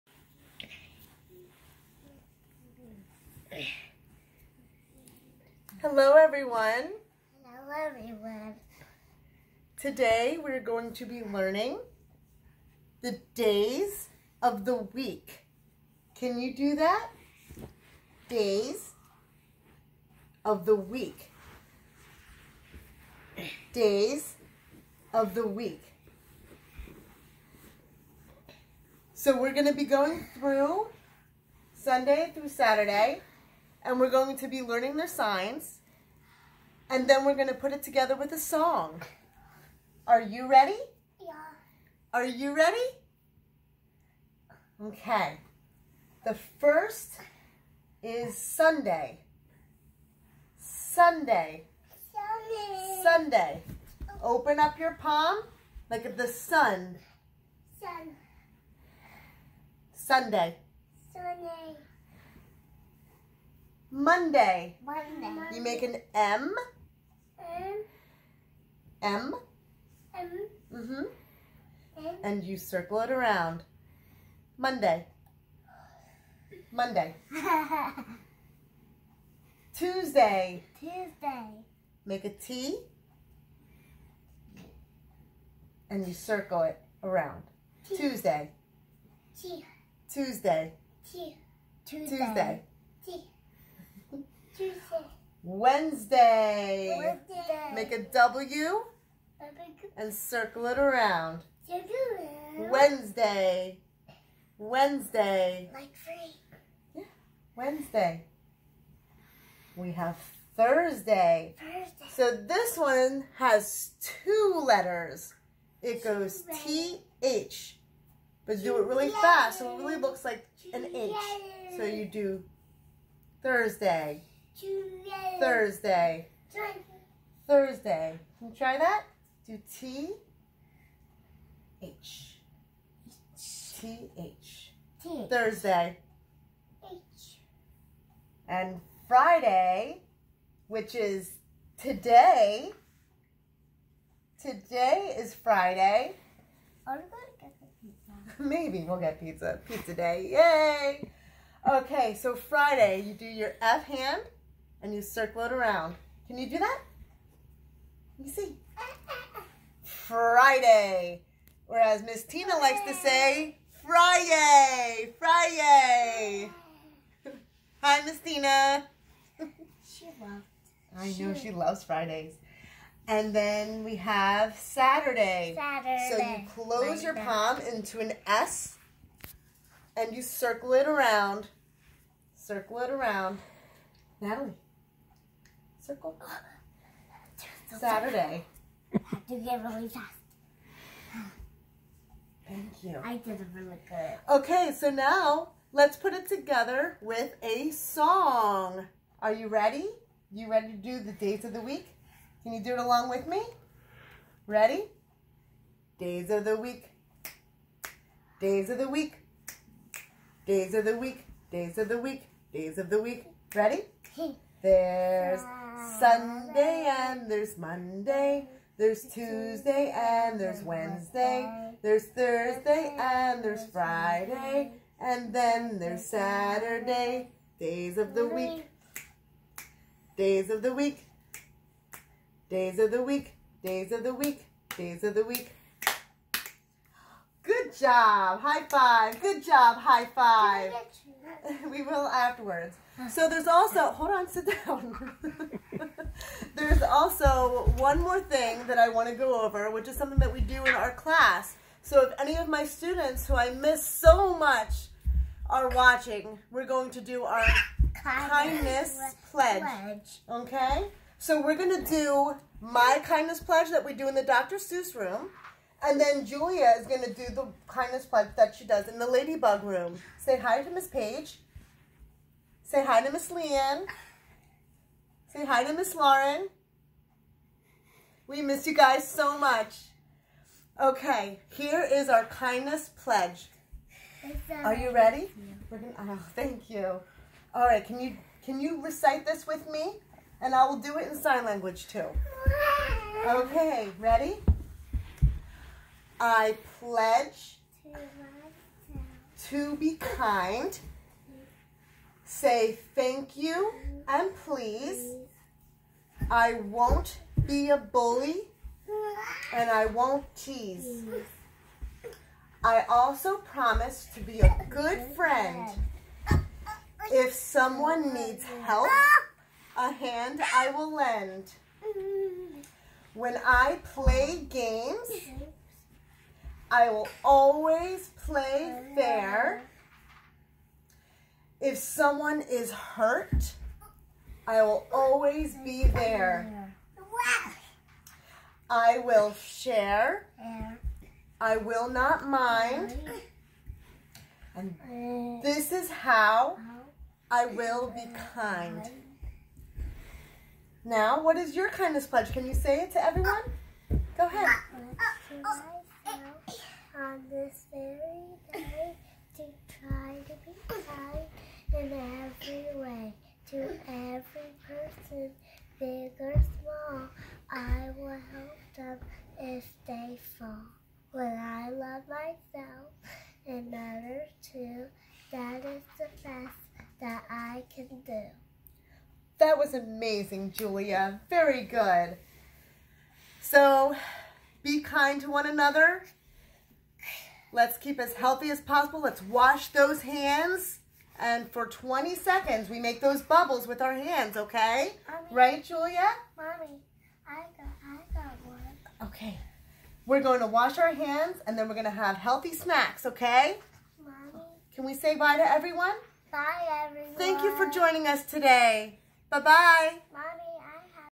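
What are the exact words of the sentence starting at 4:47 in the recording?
All right, can you can you recite this with me?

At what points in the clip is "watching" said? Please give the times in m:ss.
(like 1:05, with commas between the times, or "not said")
4:15.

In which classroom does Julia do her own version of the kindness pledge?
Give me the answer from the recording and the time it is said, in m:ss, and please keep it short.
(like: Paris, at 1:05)
Ladybug room, at 4:29.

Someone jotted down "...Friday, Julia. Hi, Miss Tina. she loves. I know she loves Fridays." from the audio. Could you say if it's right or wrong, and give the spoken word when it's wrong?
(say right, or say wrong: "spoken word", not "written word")
wrong: "Friday", not "Julia".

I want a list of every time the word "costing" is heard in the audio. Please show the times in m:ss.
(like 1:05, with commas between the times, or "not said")
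not said.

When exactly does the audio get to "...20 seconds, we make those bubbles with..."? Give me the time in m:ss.
6:31.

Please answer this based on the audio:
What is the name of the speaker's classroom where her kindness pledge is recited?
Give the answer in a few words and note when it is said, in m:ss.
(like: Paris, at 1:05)
Dr. Seuss room, at 4:24.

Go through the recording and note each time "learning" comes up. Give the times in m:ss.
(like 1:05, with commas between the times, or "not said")
0:11, 0:34.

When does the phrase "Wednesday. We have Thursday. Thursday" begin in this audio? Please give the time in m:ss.
1:47.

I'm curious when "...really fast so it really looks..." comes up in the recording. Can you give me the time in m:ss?
1:58.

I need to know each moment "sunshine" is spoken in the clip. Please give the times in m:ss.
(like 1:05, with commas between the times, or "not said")
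not said.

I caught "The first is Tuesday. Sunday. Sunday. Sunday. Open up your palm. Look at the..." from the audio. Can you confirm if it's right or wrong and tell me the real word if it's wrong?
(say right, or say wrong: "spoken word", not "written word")
wrong: "Sunday", not "Tuesday".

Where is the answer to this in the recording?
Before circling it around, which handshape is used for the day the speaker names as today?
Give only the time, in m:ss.
2:33.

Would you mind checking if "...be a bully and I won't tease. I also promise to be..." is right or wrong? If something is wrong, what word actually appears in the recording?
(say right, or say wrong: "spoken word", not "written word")
right.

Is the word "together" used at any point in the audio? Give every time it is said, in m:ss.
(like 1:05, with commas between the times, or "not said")
0:37, 3:16.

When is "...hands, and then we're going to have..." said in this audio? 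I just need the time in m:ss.
6:40.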